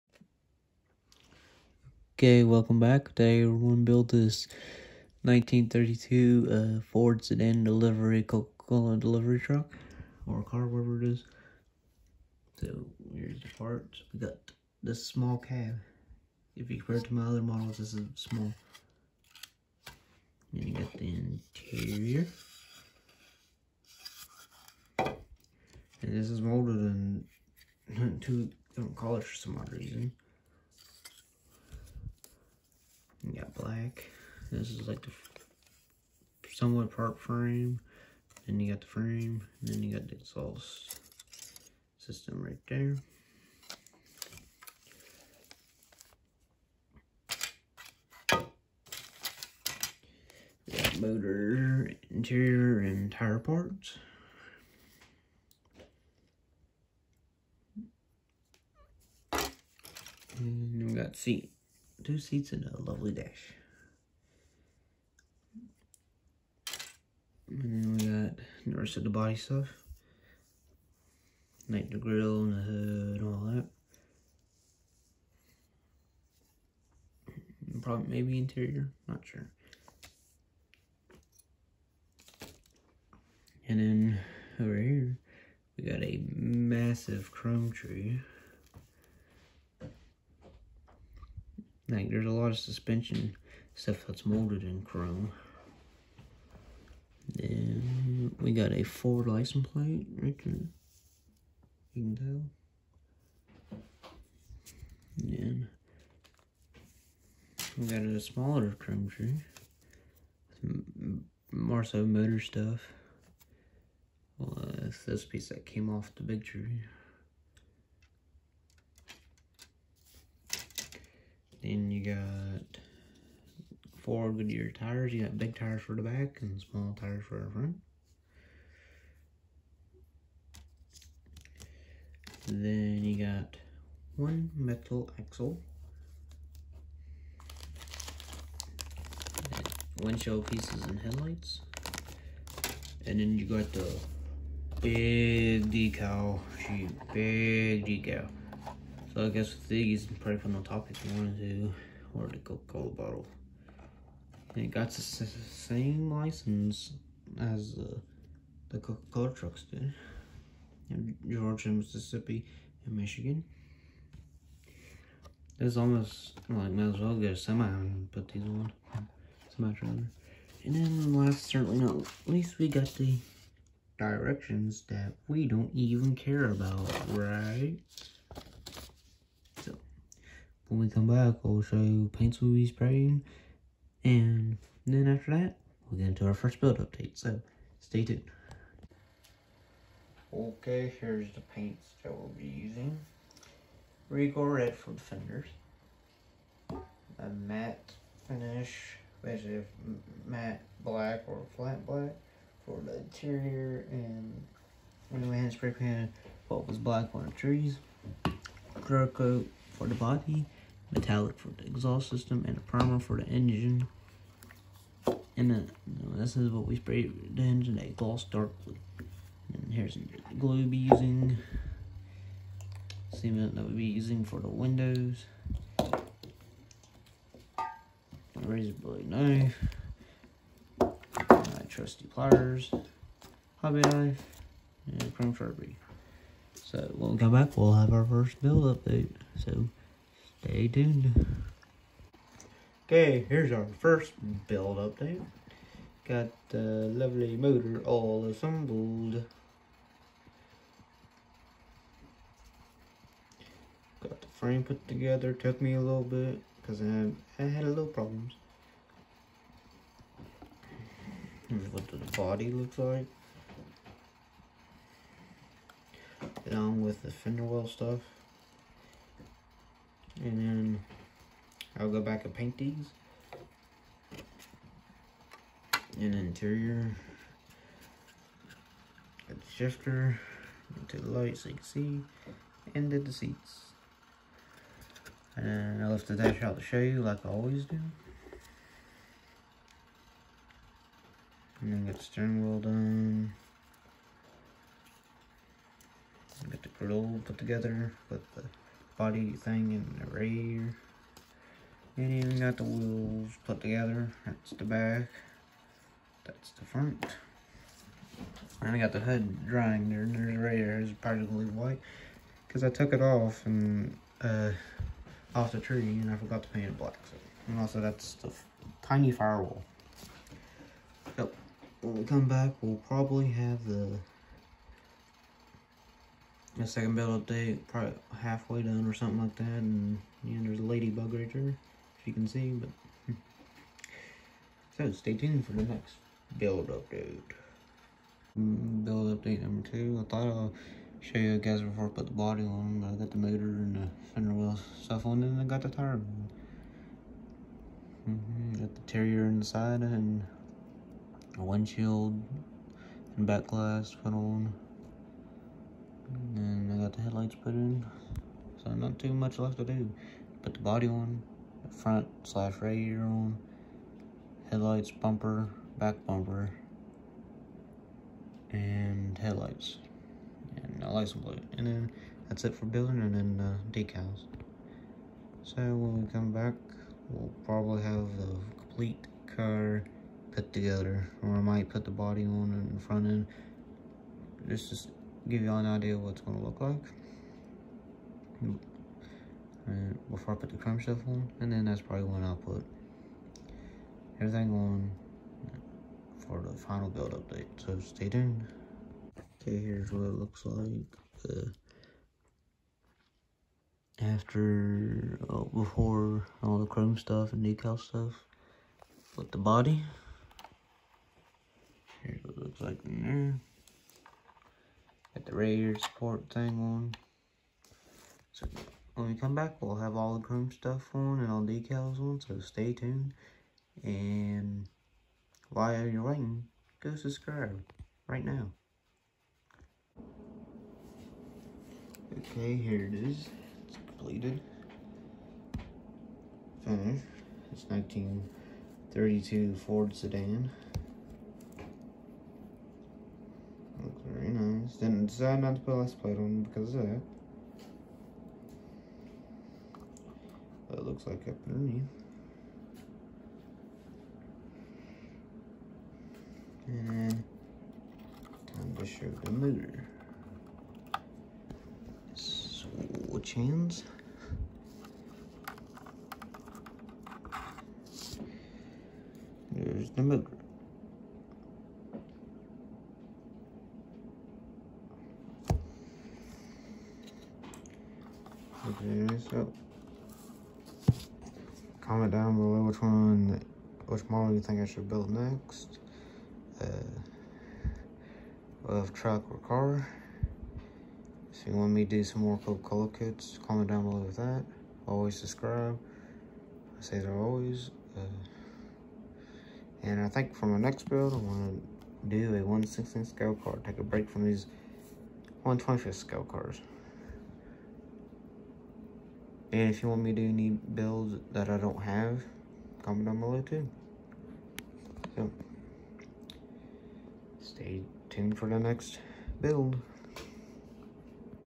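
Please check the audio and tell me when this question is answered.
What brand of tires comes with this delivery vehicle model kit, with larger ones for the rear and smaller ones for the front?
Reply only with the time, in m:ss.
2:04.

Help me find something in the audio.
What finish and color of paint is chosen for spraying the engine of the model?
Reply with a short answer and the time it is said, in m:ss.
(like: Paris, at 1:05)
Gloss dark blue, at 3:37.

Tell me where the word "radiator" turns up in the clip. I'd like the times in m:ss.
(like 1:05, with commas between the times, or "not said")
6:02, 6:55.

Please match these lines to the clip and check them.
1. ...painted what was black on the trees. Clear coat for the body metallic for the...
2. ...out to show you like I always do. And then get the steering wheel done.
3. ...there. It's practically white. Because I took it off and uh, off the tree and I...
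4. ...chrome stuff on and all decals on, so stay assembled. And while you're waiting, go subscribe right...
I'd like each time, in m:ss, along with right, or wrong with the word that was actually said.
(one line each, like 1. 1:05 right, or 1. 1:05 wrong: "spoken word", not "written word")
1. 3:25 right
2. 4:46 right
3. 5:10 right
4. 7:00 wrong: "tuned", not "assembled".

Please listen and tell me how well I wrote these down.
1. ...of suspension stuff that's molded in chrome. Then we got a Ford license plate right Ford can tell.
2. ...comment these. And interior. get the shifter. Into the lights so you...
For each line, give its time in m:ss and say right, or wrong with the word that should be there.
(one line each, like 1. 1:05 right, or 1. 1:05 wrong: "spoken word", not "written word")
1. 1:32 wrong: "You", not "Ford"
2. 4:32 wrong: "paint", not "comment".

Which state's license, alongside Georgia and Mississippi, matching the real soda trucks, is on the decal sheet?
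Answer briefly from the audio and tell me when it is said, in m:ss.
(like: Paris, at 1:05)
Michigan, at 2:42.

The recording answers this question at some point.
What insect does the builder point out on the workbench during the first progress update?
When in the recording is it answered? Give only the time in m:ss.
5:30.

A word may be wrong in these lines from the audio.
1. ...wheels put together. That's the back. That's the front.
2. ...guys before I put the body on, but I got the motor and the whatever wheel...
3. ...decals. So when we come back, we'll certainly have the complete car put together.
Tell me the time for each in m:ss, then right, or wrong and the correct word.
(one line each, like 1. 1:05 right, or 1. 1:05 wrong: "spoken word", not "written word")
1. 5:02 right
2. 5:41 wrong: "fender", not "whatever"
3. 6:13 wrong: "probably", not "certainly".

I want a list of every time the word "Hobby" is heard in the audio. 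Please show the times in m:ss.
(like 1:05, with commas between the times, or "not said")
3:53.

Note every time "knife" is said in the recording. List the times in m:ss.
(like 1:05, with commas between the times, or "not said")
3:49, 3:53.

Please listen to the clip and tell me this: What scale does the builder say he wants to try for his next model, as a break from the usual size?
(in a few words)
1/16.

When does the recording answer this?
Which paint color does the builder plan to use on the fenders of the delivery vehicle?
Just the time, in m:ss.
3:14.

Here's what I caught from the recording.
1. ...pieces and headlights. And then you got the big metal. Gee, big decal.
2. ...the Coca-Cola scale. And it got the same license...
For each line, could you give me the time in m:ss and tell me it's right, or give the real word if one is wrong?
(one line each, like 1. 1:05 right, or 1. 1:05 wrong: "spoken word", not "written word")
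1. 2:20 wrong: "decal", not "metal"
2. 2:32 wrong: "bottle", not "scale".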